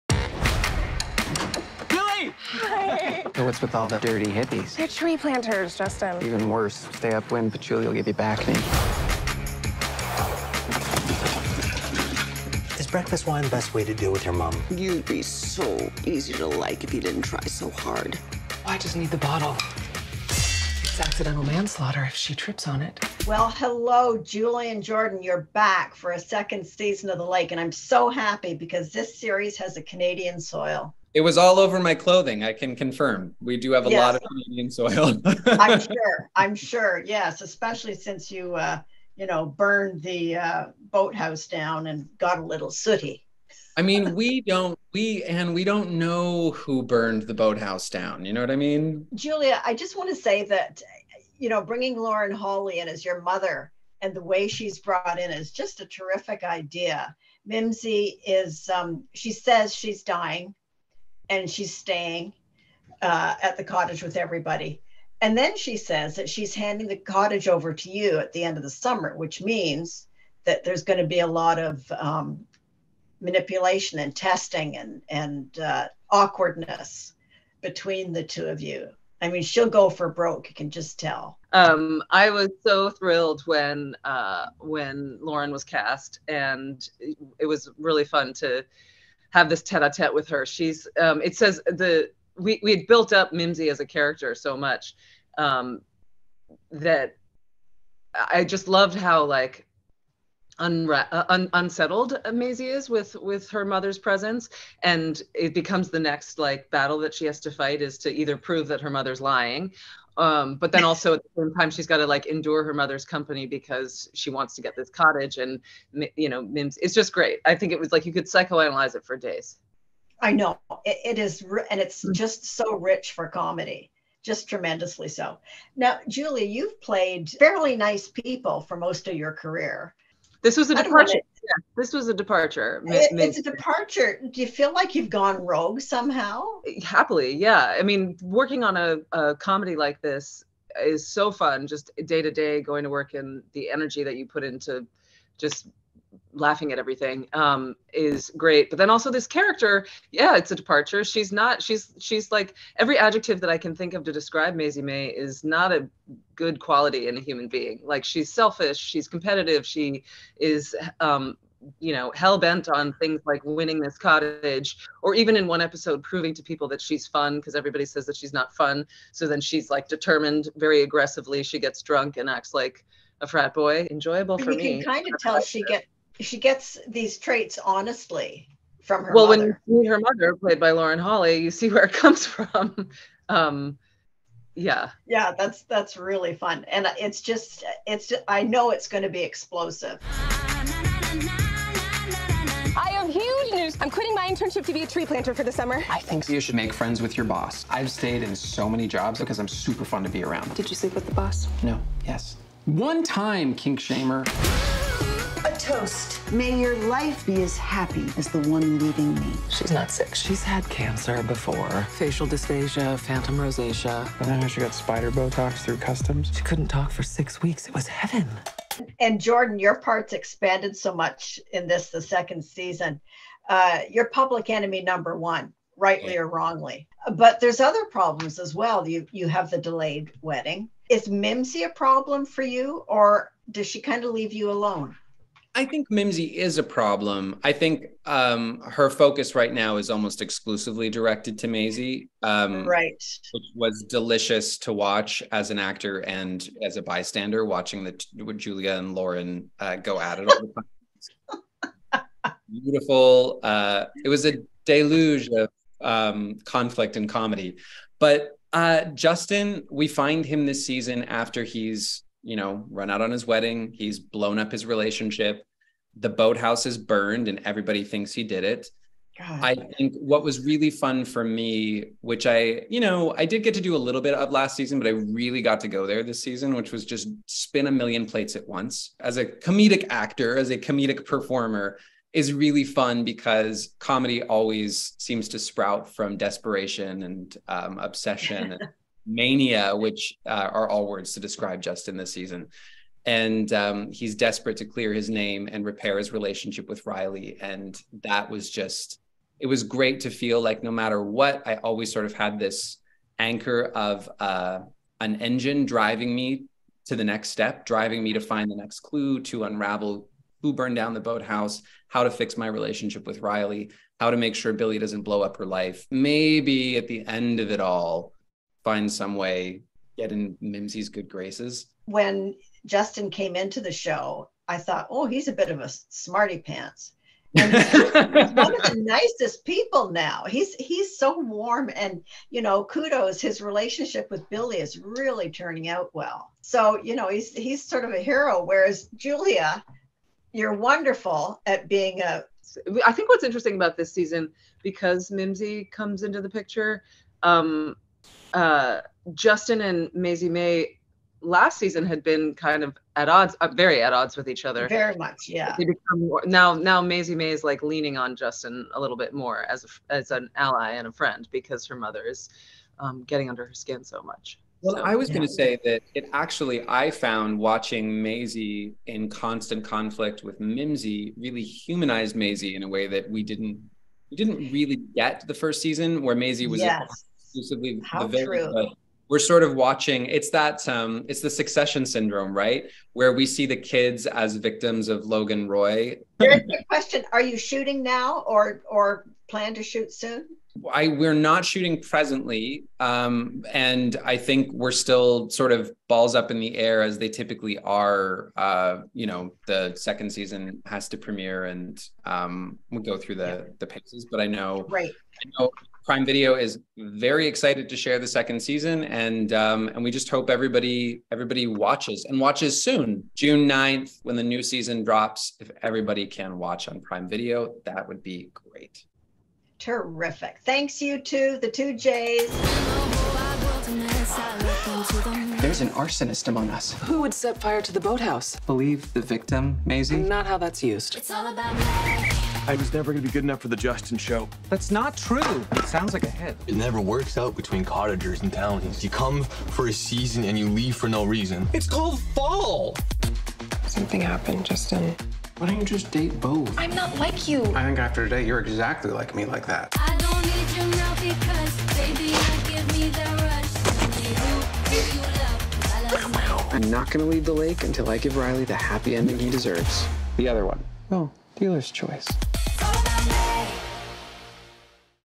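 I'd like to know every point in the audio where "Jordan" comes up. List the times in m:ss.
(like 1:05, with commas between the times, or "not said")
0:24, 3:39.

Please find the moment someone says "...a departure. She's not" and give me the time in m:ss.
2:30.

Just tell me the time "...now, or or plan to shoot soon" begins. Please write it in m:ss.
6:27.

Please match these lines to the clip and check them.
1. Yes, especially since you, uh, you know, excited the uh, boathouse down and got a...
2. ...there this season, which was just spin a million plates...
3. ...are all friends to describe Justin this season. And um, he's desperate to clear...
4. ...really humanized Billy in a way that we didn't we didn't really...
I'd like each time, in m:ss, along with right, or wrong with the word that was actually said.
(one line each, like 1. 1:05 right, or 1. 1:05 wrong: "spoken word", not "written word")
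1. 0:37 wrong: "burned", not "excited"
2. 4:35 right
3. 4:50 wrong: "words", not "friends"
4. 6:11 wrong: "Maisie", not "Billy".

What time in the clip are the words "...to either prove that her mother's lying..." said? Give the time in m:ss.
1:47.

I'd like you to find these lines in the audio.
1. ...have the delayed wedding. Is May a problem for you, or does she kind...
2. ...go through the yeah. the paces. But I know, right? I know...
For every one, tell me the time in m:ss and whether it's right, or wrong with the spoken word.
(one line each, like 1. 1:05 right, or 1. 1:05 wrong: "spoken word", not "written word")
1. 3:49 wrong: "Mimsy", not "May"
2. 6:42 right.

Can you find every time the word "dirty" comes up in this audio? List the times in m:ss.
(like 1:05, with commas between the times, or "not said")
0:03.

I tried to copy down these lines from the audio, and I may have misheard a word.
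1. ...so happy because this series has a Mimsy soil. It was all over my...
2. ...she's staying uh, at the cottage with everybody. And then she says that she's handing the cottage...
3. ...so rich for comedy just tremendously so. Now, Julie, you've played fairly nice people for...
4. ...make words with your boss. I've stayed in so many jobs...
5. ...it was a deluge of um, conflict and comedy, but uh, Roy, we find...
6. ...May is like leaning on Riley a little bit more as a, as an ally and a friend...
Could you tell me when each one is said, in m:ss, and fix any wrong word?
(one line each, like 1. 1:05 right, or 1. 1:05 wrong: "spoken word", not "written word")
1. 0:27 wrong: "Canadian", not "Mimsy"
2. 1:01 right
3. 2:02 right
4. 3:16 wrong: "friends", not "words"
5. 4:14 wrong: "Justin", not "Roy"
6. 5:57 wrong: "Justin", not "Riley".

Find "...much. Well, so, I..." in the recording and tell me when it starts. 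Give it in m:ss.
6:04.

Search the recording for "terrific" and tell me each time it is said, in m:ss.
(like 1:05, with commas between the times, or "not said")
0:55, 6:59.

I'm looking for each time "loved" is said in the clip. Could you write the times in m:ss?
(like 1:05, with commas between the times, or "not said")
1:38.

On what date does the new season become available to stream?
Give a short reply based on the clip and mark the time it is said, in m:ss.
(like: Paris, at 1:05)
June 9, at 6:53.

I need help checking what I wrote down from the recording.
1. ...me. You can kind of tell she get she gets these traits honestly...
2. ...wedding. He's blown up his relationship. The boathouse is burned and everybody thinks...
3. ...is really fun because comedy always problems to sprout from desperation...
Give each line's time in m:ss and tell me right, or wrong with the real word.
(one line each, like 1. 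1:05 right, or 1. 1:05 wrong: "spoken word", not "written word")
1. 2:54 right
2. 4:23 right
3. 4:42 wrong: "seems", not "problems".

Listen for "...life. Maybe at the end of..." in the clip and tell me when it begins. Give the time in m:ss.
5:15.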